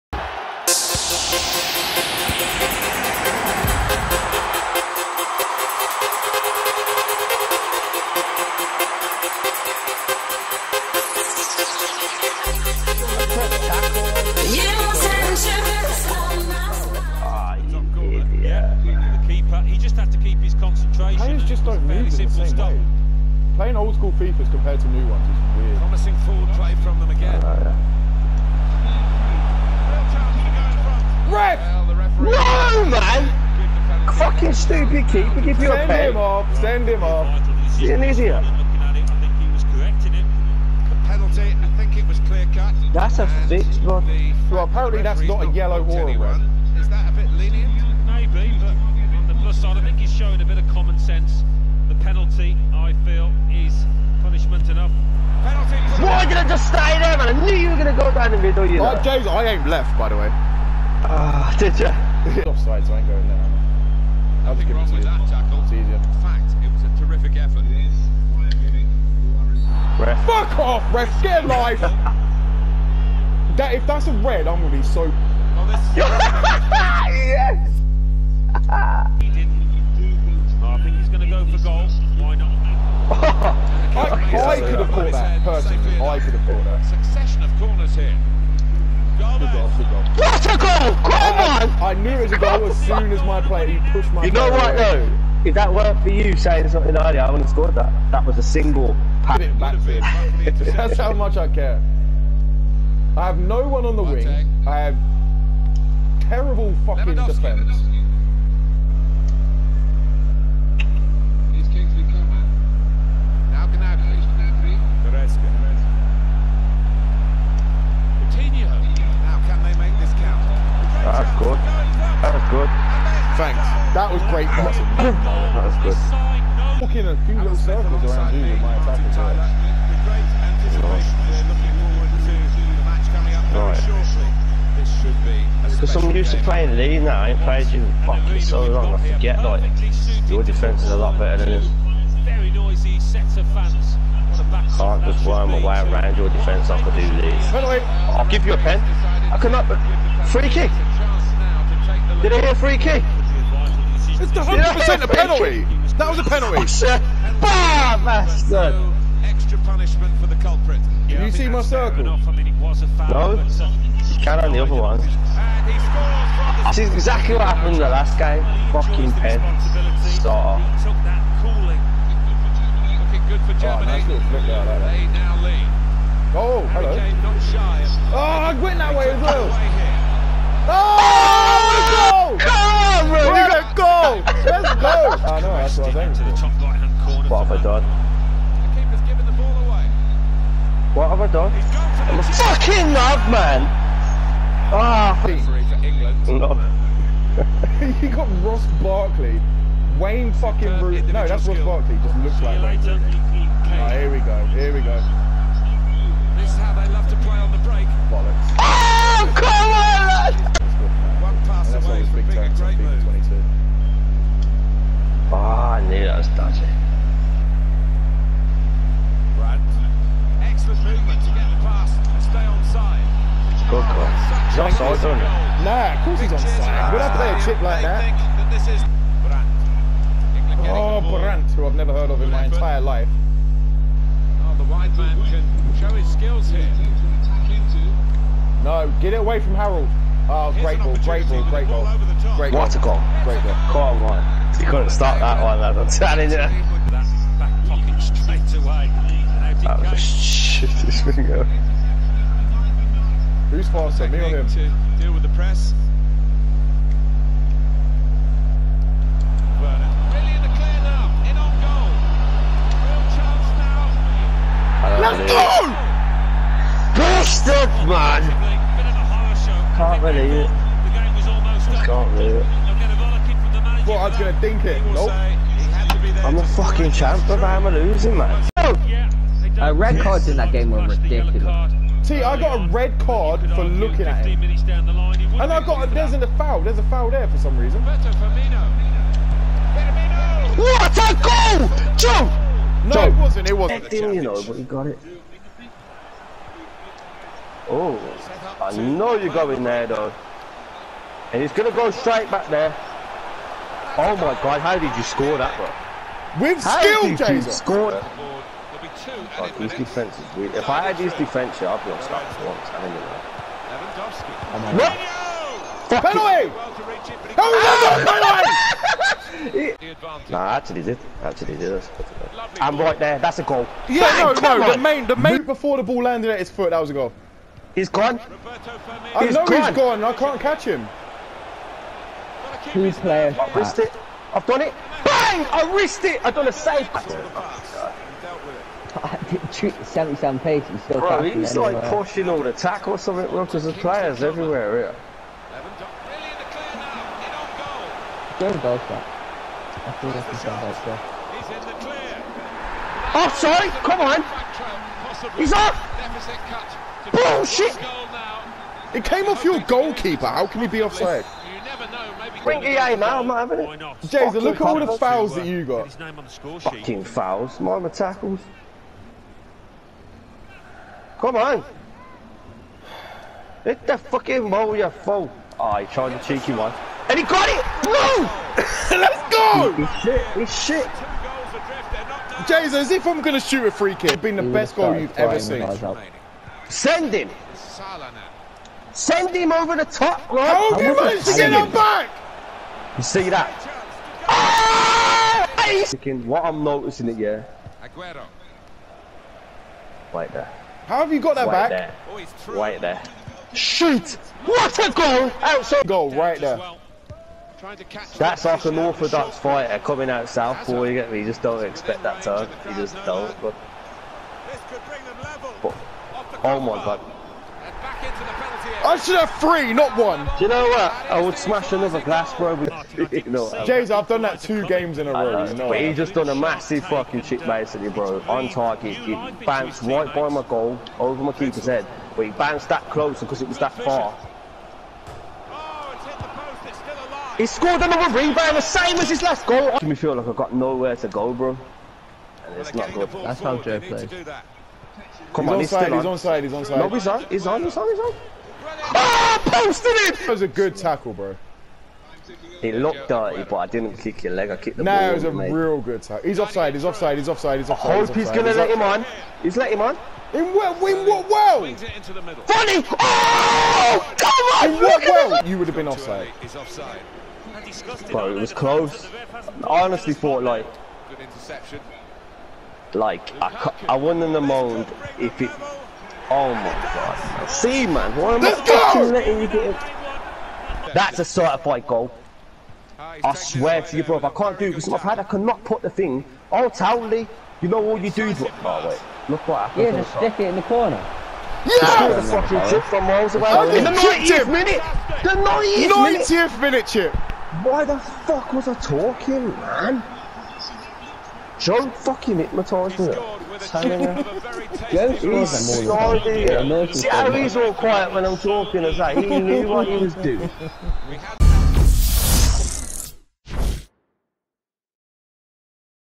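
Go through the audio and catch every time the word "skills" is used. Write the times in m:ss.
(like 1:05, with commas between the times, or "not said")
3:56, 5:06.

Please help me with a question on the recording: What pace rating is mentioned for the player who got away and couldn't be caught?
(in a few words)
77.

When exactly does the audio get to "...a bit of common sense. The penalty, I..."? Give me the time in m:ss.
0:50.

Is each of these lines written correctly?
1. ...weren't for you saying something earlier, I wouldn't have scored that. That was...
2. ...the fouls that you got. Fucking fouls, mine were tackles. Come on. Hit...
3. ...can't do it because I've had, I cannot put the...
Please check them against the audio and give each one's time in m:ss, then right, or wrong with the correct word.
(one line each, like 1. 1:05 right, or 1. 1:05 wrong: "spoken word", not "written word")
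1. 1:35 right
2. 6:04 right
3. 8:04 right.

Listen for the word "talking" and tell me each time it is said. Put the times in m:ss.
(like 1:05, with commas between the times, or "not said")
8:18, 8:28.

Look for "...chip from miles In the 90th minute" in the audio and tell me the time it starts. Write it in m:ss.
8:12.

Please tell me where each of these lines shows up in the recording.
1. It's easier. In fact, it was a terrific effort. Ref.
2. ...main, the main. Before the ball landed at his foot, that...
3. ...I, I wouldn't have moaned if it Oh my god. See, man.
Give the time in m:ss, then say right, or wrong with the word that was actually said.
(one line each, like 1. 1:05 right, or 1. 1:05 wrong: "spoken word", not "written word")
1. 1:05 right
2. 5:24 right
3. 7:53 right.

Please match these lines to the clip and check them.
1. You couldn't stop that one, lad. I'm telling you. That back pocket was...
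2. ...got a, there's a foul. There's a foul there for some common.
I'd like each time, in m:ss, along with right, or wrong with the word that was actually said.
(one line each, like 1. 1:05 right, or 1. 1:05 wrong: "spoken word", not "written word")
1. 4:04 right
2. 4:45 wrong: "reason", not "common".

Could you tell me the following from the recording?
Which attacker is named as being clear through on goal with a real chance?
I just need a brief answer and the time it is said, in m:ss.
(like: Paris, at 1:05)
Werner, at 4:19.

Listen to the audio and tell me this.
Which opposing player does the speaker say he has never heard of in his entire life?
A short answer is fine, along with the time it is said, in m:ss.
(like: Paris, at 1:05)
Brandt, at 3:51.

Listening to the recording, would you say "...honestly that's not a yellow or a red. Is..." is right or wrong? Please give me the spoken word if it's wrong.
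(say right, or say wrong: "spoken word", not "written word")
wrong: "apparently", not "honestly".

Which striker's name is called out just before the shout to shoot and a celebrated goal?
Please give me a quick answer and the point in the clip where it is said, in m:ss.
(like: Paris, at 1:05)
Aguero, at 6:37.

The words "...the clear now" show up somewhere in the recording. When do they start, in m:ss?
5:44.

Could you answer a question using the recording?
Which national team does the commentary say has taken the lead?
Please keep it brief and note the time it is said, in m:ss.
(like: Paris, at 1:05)
Germany, at 2:53.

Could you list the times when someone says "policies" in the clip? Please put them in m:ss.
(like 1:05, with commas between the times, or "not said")
not said.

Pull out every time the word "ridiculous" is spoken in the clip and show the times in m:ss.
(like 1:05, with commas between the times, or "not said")
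4:40.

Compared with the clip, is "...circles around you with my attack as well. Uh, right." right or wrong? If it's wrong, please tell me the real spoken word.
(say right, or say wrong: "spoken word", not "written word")
right.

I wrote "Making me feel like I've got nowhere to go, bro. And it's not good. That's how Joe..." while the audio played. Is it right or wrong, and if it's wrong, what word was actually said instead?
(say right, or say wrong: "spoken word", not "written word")
right.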